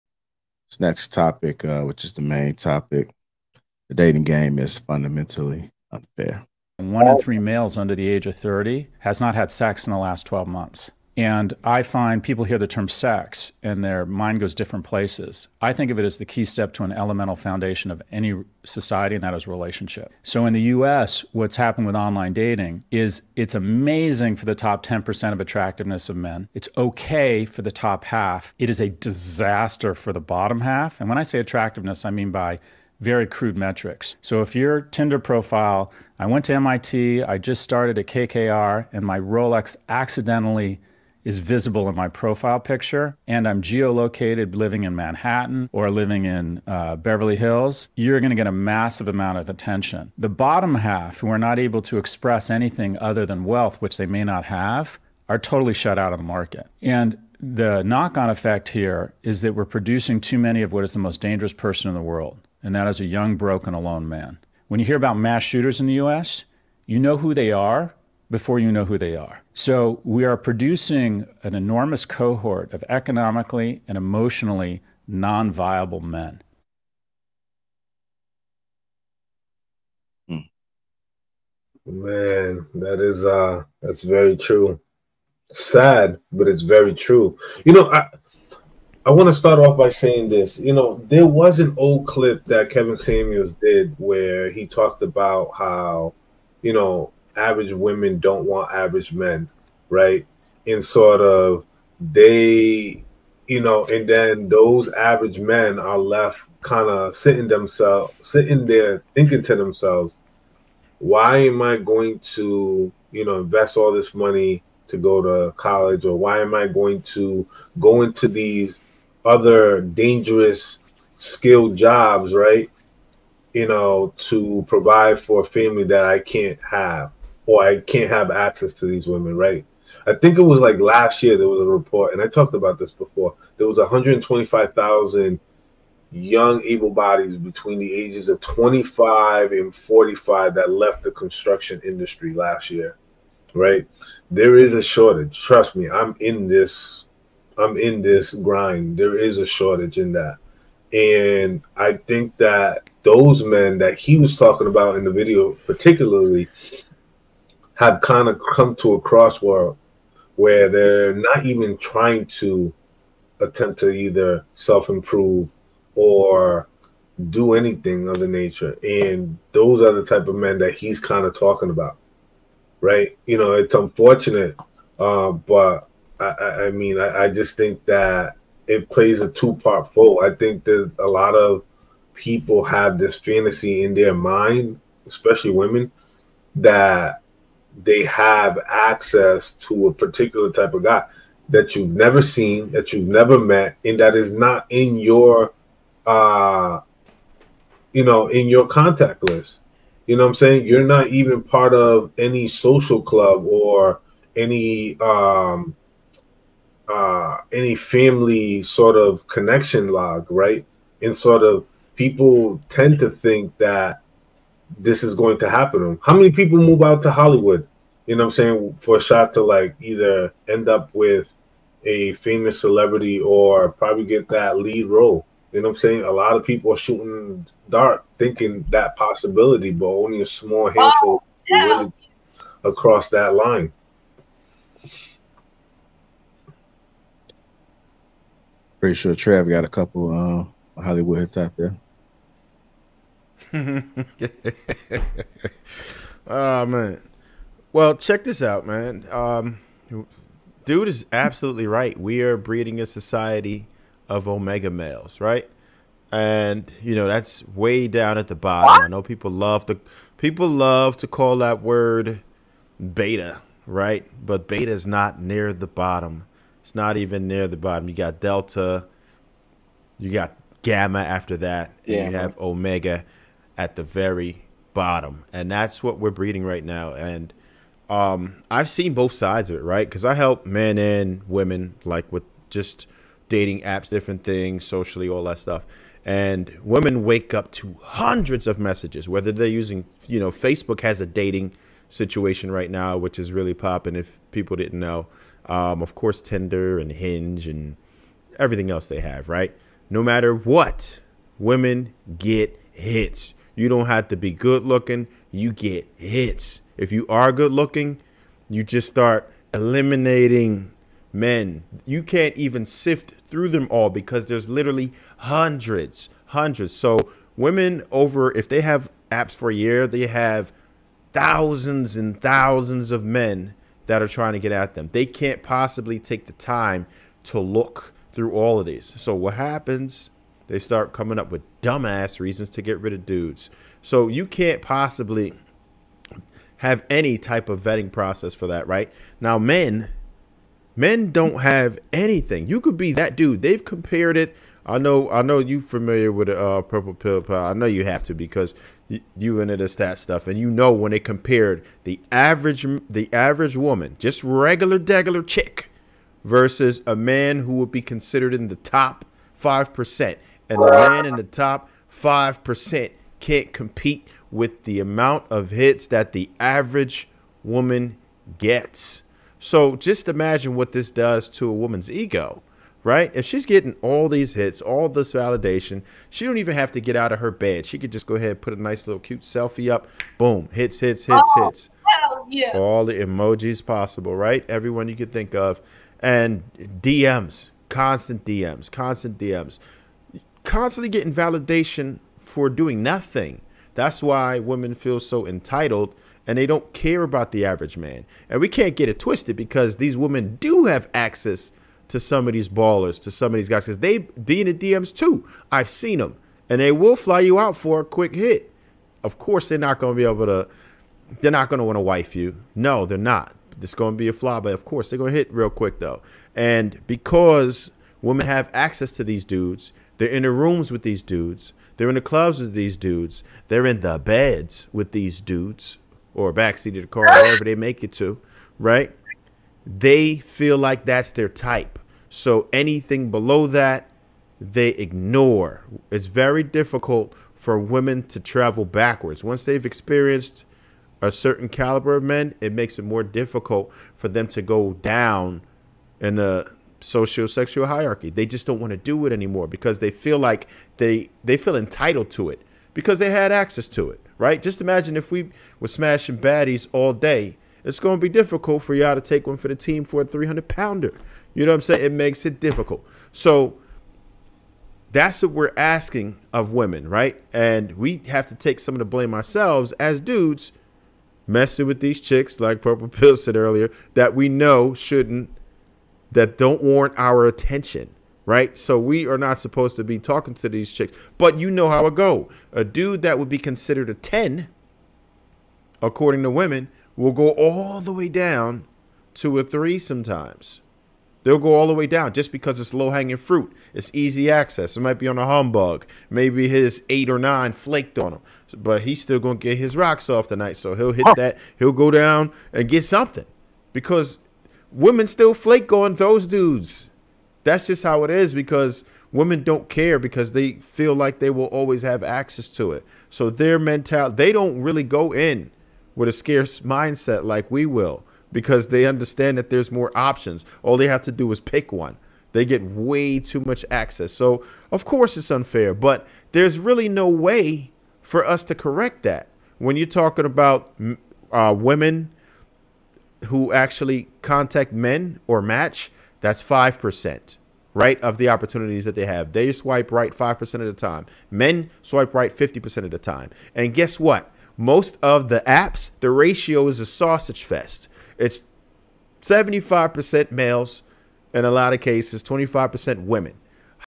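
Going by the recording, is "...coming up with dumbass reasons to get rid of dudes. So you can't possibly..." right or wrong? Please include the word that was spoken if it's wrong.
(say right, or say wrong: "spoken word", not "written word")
right.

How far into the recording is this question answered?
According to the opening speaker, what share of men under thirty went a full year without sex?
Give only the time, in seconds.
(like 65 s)
6 s.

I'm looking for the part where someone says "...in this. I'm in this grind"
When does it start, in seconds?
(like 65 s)
146 s.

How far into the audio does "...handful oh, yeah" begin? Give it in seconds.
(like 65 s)
230 s.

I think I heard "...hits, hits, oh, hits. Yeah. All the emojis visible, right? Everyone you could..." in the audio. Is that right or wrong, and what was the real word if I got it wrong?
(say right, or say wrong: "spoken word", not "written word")
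wrong: "possible", not "visible".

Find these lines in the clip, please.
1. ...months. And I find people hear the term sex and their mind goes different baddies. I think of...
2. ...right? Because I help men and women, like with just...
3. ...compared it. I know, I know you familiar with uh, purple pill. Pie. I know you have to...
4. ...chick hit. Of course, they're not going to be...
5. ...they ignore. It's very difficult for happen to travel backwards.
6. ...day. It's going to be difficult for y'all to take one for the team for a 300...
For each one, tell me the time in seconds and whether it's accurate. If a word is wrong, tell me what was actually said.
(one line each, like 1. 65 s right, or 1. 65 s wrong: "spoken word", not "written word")
1. 10 s wrong: "places", not "baddies"
2. 279 s right
3. 343 s right
4. 407 s wrong: "quick", not "chick"
5. 434 s wrong: "women", not "happen"
6. 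456 s right.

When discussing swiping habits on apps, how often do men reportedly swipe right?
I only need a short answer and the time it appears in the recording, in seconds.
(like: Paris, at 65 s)
50%, at 542 s.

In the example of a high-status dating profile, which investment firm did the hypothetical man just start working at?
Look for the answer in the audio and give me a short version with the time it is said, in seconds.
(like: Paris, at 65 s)
KKR, at 38 s.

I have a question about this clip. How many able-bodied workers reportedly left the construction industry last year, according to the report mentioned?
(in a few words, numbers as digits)
125,000.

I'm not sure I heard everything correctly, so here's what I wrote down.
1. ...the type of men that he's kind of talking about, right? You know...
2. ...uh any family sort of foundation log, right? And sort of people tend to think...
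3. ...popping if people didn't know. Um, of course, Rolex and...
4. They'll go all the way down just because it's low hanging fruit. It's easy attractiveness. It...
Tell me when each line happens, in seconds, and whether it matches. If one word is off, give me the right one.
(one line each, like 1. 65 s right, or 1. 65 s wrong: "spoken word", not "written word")
1. 169 s right
2. 206 s wrong: "connection", not "foundation"
3. 293 s wrong: "Tinder", not "Rolex"
4. 491 s wrong: "access", not "attractiveness".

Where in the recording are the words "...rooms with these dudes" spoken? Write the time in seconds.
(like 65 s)
420 s.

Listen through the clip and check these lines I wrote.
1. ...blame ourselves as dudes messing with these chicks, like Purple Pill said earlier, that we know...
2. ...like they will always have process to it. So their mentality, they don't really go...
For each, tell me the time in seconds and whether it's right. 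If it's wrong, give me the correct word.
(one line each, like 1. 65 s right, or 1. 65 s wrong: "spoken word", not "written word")
1. 468 s right
2. 510 s wrong: "access", not "process".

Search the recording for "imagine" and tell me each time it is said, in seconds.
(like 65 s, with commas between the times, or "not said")
370 s, 454 s.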